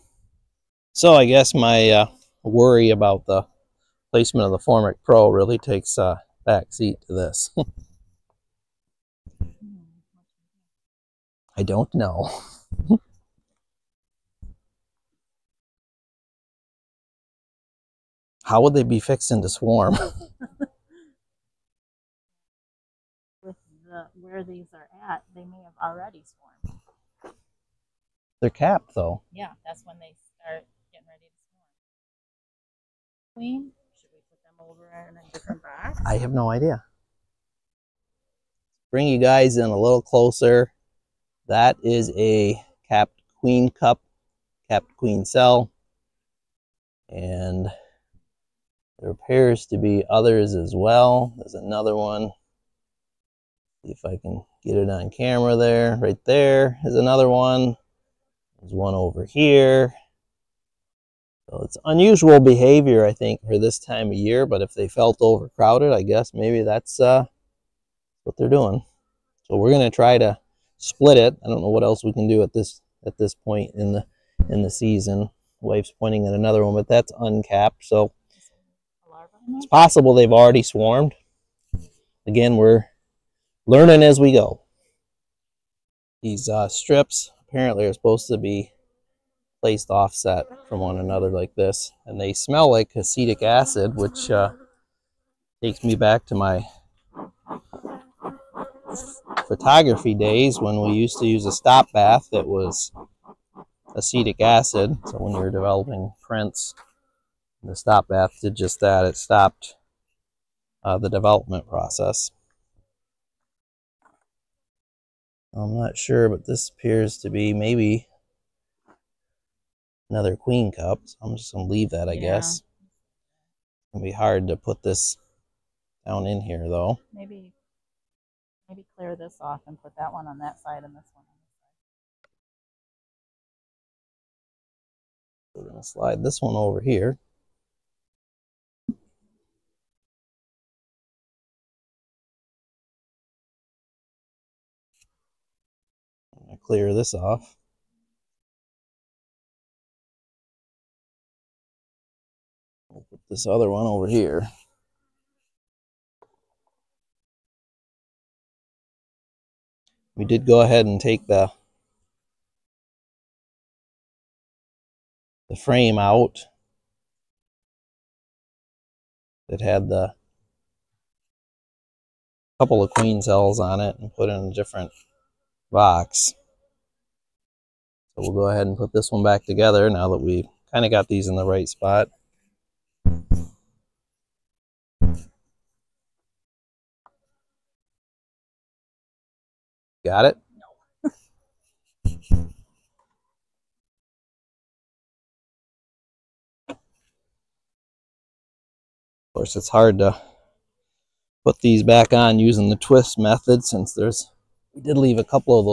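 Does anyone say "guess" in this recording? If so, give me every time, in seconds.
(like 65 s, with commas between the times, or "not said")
1 s, 66 s, 122 s.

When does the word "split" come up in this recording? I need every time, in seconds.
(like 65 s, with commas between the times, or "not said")
70 s.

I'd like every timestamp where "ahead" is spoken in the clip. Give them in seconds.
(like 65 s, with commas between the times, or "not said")
160 s, 178 s.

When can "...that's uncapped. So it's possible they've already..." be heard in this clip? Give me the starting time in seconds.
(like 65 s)
76 s.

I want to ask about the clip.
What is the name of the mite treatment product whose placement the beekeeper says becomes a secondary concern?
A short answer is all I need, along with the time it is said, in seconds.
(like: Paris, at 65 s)
Formic Pro, at 4 s.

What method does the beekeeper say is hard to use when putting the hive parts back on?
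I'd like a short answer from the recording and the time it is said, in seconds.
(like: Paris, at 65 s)
twist method, at 202 s.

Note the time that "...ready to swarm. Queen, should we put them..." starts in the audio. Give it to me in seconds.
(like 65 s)
31 s.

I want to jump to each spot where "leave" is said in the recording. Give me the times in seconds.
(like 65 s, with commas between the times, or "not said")
121 s, 204 s.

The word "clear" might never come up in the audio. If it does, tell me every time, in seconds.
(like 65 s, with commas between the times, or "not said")
128 s, 146 s.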